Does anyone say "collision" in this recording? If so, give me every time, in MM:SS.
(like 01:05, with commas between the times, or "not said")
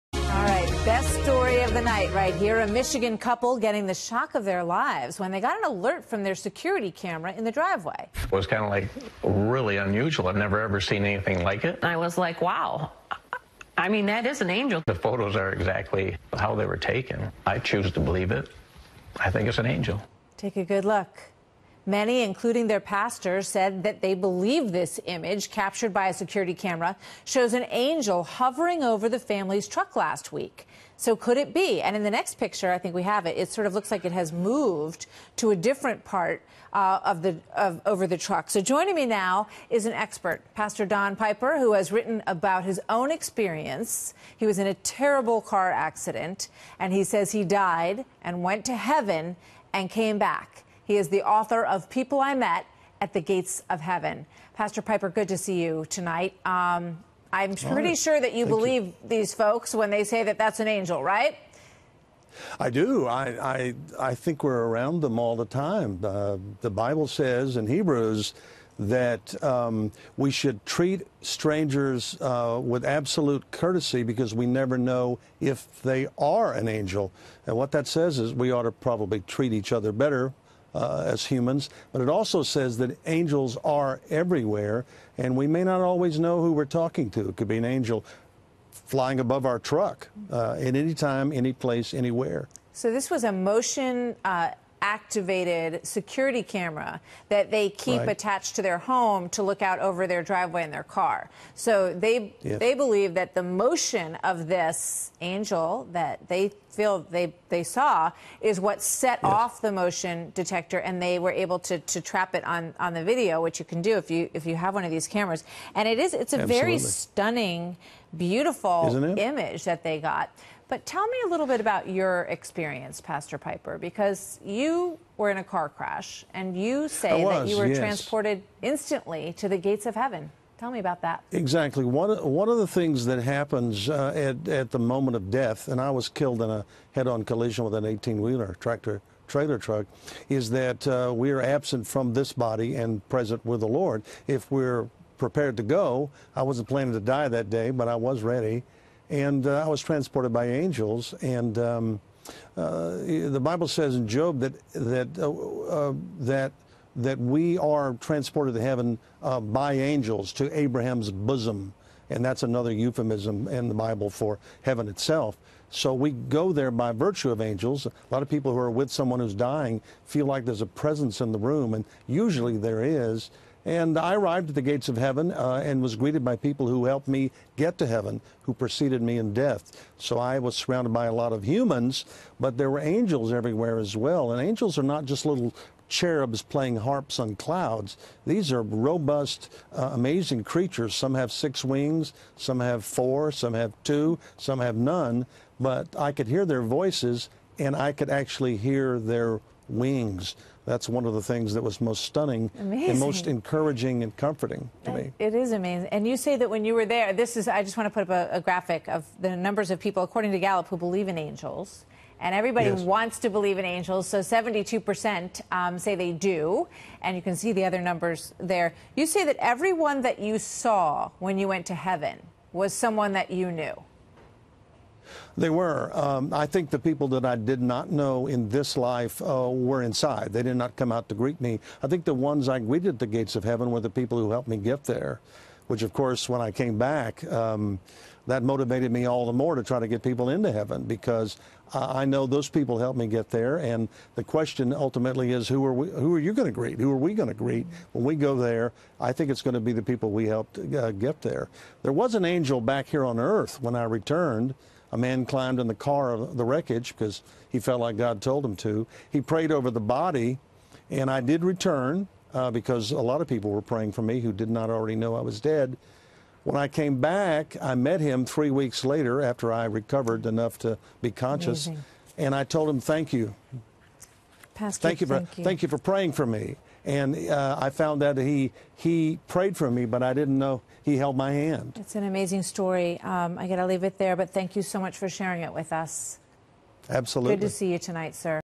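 02:17.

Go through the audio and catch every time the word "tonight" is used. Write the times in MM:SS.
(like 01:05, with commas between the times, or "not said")
00:55, 04:47.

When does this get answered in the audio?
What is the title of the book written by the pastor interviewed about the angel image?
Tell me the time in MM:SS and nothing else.
00:51.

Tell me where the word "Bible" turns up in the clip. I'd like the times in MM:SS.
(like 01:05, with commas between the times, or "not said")
01:06, 02:33, 02:43.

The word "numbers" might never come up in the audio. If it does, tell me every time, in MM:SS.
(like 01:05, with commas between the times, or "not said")
03:29, 03:37.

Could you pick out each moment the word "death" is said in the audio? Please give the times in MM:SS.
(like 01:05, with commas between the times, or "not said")
02:15, 02:59.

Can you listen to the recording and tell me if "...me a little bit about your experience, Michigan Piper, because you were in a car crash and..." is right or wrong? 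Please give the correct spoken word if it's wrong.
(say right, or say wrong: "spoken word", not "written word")
wrong: "Pastor", not "Michigan".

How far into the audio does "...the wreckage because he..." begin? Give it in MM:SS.
04:16.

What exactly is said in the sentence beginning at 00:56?
Um, I'm pretty sure that you Thank believe you.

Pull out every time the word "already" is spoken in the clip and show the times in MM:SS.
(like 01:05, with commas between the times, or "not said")
04:24.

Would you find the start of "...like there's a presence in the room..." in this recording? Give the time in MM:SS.
02:50.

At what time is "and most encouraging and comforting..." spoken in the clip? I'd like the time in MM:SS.
03:22.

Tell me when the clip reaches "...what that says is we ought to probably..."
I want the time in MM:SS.
01:17.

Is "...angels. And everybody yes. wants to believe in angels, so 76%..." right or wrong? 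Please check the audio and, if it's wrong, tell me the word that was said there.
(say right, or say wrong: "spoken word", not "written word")
wrong: "72", not "76".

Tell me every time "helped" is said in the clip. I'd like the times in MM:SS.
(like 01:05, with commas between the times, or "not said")
02:56, 03:54, 04:02, 04:10.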